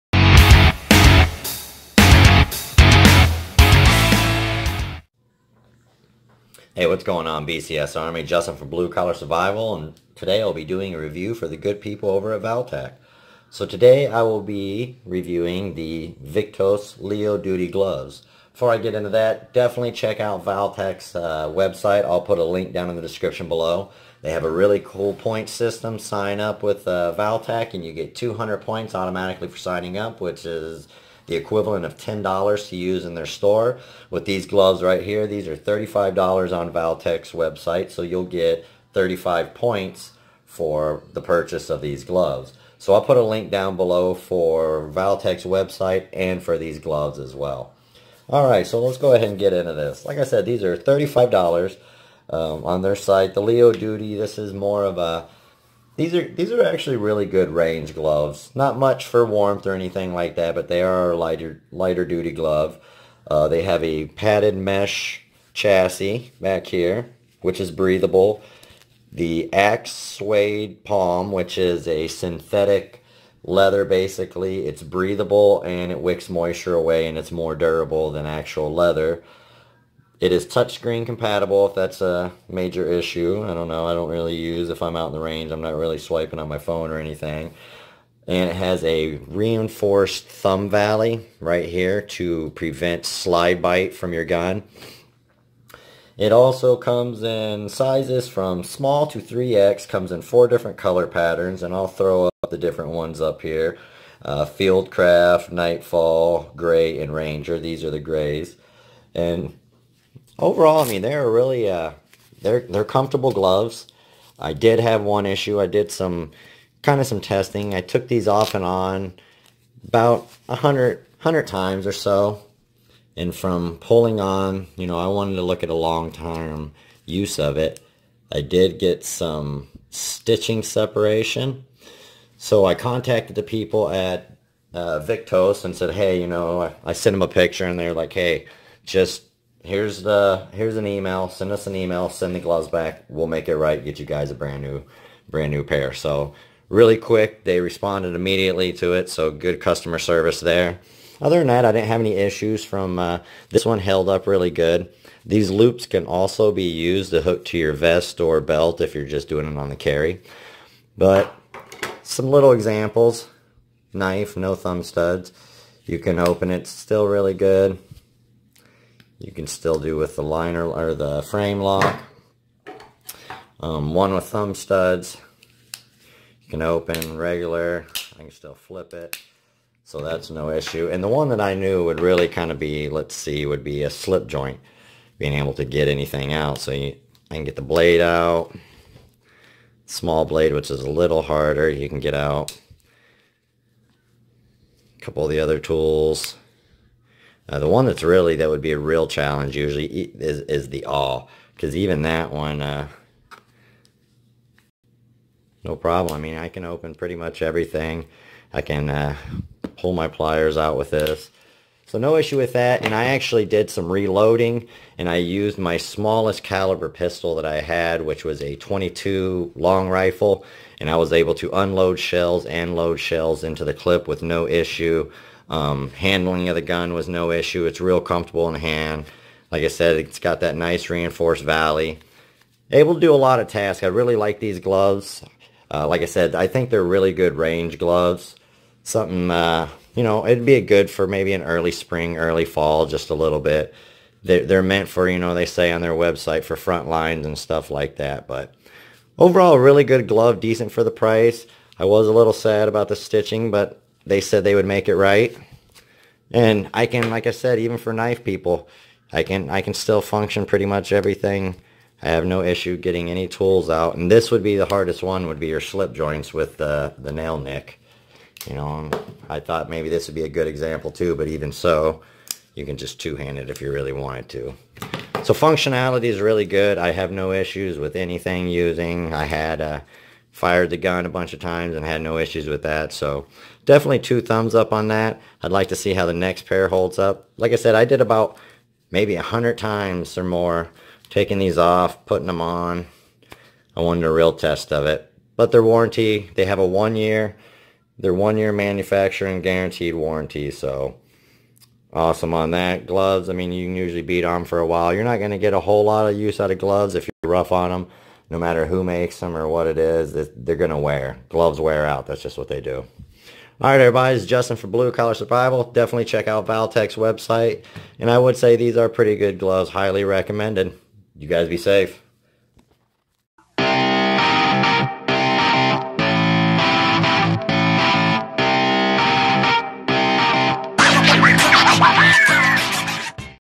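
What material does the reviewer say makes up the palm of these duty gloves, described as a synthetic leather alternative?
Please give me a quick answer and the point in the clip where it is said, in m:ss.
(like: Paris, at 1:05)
Axe Suede, at 1:09.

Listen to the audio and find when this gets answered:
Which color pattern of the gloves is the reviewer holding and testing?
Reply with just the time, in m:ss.
1:47.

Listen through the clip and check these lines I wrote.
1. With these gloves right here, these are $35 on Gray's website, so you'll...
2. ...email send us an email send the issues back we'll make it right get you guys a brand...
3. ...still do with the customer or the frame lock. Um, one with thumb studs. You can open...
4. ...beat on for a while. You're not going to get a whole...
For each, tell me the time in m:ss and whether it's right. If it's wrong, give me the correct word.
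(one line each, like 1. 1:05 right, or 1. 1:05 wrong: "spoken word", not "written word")
1. 0:34 wrong: "ValTac", not "Gray"
2. 2:20 wrong: "gloves", not "issues"
3. 2:49 wrong: "liner", not "customer"
4. 5:04 right.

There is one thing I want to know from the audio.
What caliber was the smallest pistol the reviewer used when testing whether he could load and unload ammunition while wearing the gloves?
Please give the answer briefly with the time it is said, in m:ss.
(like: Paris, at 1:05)
22 long rifle, at 3:38.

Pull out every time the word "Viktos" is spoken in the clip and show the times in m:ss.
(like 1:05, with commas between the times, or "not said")
0:16, 2:15.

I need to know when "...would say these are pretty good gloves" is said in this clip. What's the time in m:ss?
5:18.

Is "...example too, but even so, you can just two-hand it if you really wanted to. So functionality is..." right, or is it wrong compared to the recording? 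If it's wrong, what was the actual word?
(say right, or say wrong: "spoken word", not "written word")
right.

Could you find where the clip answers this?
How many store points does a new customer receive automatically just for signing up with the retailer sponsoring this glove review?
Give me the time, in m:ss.
0:28.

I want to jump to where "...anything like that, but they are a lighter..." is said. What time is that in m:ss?
0:59.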